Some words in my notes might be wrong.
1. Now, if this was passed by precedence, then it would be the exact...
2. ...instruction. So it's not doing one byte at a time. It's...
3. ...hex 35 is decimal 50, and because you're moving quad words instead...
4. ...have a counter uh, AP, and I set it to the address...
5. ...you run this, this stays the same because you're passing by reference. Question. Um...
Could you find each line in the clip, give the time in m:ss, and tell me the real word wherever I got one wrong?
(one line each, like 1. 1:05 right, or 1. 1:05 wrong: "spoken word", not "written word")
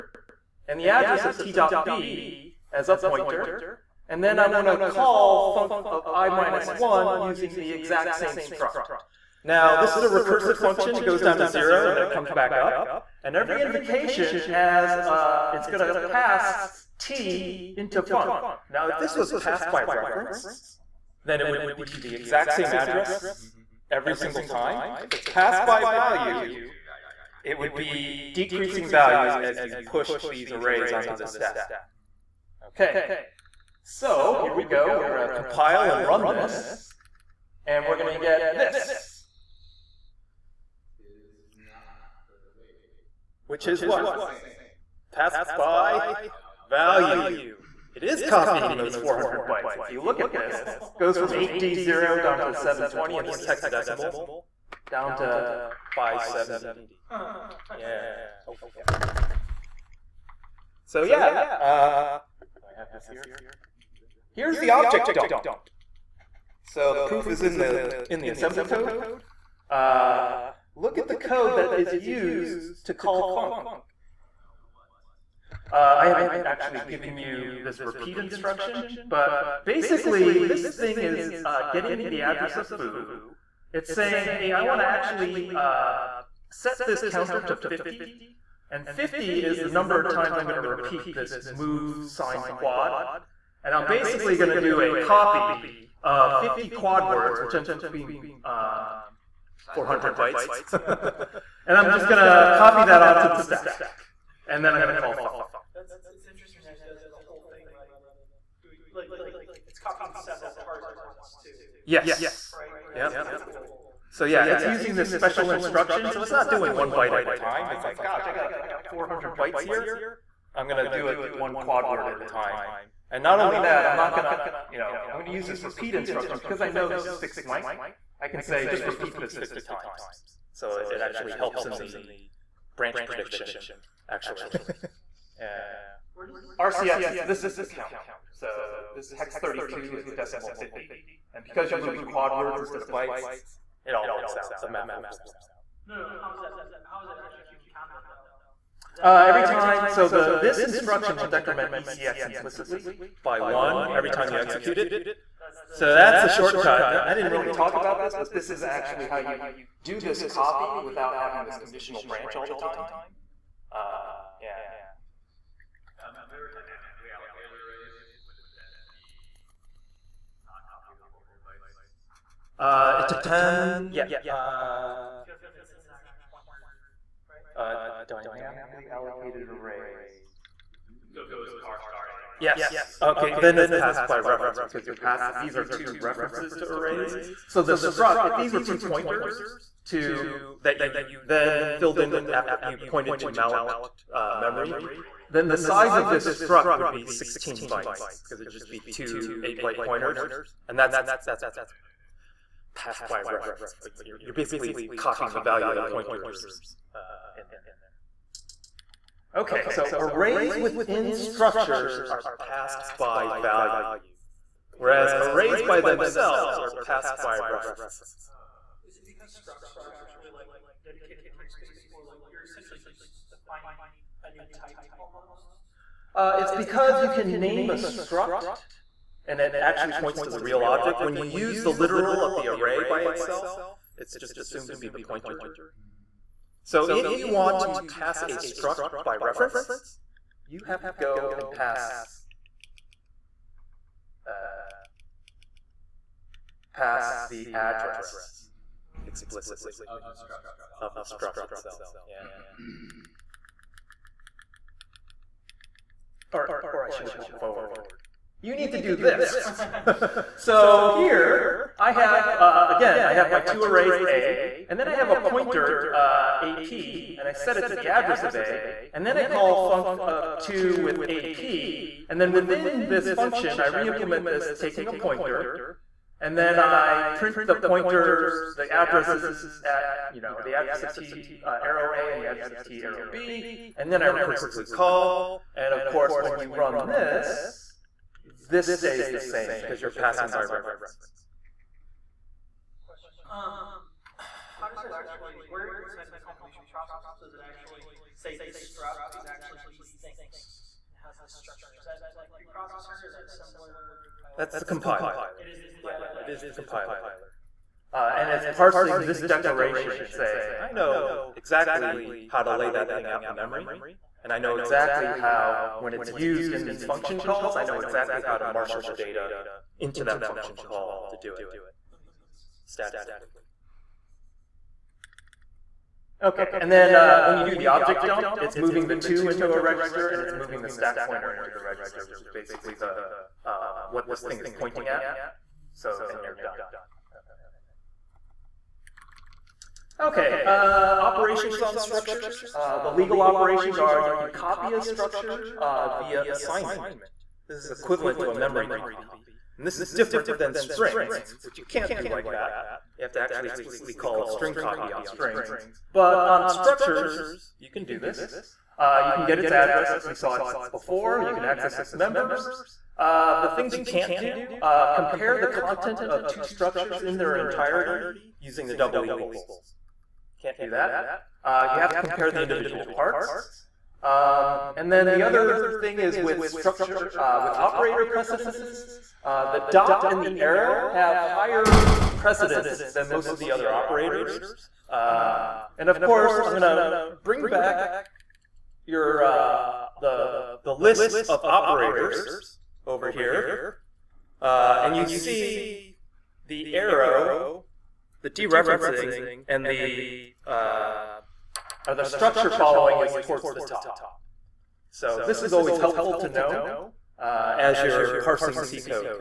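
1. 0:18 wrong: "reference", not "precedence"
2. 1:55 right
3. 2:19 wrong: "32", not "35"
4. 4:24 wrong: "pointer", not "counter"
5. 4:46 right.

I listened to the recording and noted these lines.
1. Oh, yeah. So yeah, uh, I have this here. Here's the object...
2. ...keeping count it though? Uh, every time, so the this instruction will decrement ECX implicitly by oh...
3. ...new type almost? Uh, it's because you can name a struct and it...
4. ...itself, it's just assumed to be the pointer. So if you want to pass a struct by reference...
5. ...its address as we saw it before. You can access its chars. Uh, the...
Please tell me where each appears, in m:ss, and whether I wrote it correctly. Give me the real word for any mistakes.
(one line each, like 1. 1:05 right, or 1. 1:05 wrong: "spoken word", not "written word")
1. 0:58 right
2. 2:27 right
3. 3:44 right
4. 3:53 right
5. 5:59 wrong: "members", not "chars".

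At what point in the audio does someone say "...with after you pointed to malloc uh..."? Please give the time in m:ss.
3:12.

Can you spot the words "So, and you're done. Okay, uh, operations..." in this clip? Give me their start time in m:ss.
5:35.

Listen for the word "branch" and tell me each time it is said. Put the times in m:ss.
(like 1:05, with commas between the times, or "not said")
2:12, 2:42.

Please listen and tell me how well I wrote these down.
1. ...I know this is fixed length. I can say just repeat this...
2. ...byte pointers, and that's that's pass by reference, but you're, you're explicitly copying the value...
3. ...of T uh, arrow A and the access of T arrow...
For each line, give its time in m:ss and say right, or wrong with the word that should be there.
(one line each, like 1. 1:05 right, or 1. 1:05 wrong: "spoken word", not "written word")
1. 2:06 right
2. 3:19 wrong: "basically", not "explicitly"
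3. 4:40 wrong: "address", not "access".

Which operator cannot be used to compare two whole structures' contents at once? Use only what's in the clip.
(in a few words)
double equals.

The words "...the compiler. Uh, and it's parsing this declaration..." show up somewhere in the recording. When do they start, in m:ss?
5:06.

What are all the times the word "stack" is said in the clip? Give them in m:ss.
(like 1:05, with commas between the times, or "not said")
0:31, 1:43, 5:30.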